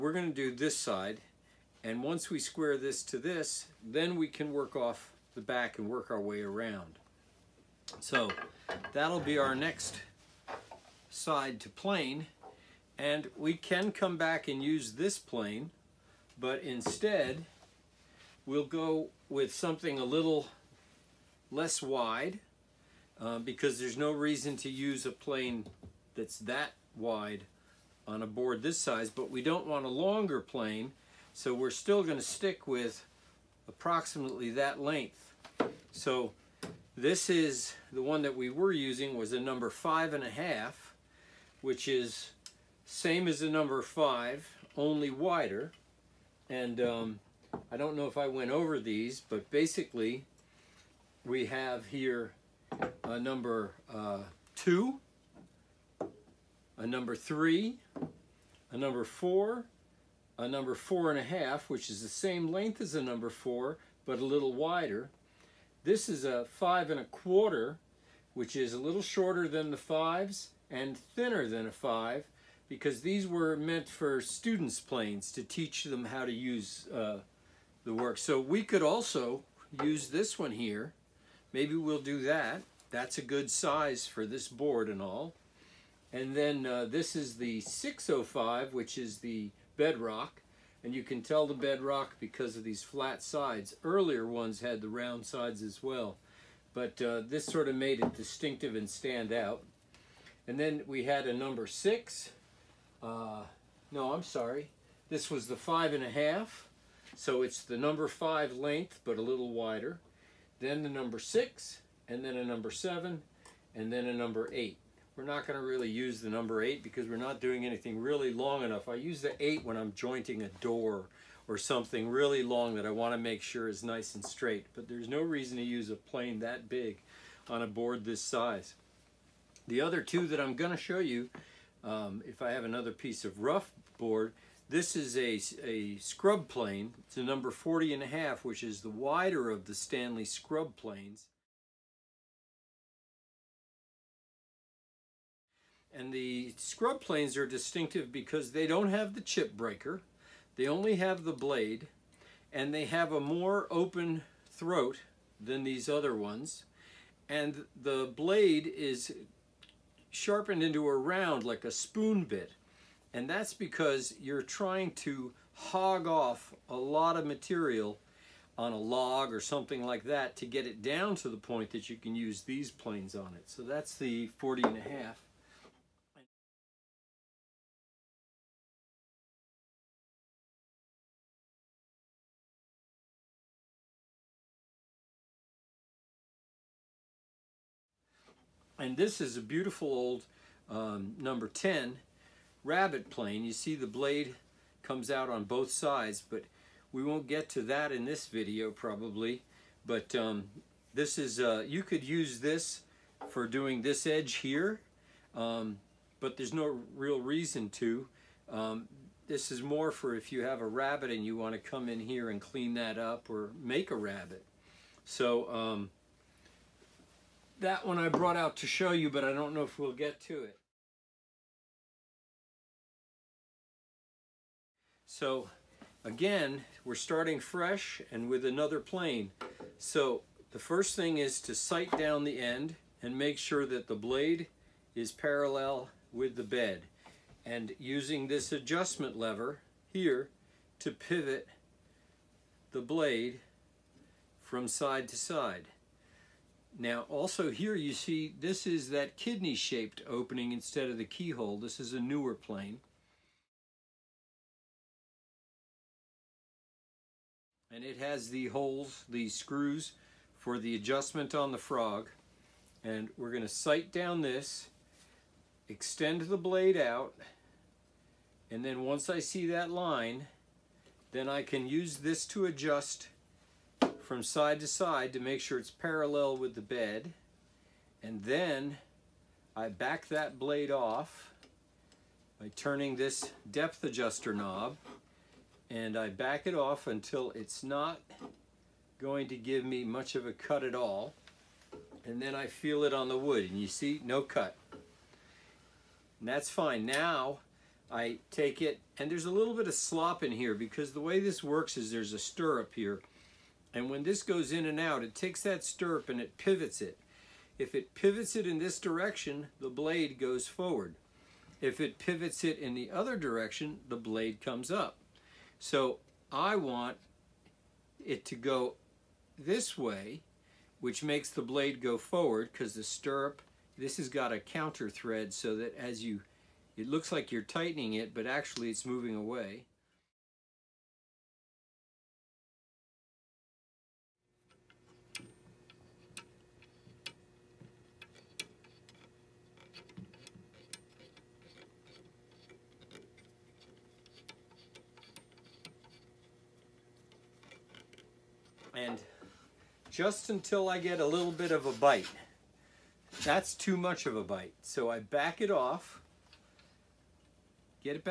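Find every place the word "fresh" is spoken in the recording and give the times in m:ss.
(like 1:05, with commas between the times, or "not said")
3:47.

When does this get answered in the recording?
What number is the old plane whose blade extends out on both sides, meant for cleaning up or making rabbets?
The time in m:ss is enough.
3:11.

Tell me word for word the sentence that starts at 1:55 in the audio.
We're not gonna really use the number eight because we're not doing anything really long enough.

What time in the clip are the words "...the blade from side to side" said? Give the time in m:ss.
4:02.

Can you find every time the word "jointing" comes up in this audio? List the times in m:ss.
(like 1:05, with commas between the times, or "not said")
1:59.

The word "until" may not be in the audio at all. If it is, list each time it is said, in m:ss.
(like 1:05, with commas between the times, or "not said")
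4:46, 5:50.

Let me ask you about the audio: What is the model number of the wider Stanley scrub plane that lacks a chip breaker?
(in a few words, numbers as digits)
40 1/2.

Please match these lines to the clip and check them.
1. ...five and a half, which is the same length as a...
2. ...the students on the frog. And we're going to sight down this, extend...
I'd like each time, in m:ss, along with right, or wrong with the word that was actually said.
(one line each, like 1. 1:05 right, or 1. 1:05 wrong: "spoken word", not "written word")
1. 1:00 wrong: "four", not "five"
2. 4:20 wrong: "adjustment", not "students".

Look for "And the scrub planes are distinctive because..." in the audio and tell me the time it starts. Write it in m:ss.
2:25.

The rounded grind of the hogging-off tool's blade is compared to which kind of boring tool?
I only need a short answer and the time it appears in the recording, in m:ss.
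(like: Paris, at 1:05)
spoon bit, at 2:41.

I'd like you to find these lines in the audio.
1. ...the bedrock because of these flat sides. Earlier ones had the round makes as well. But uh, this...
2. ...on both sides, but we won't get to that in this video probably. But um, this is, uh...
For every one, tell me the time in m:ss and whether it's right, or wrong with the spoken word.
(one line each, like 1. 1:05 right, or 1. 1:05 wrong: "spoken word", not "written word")
1. 1:31 wrong: "sides", not "makes"
2. 3:15 right.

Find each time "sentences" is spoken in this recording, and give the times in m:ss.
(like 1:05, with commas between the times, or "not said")
not said.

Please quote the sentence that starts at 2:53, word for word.
So that's the 40 and a half.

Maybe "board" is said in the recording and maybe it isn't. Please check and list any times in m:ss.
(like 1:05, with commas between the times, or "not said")
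0:28, 1:24, 2:07, 2:13.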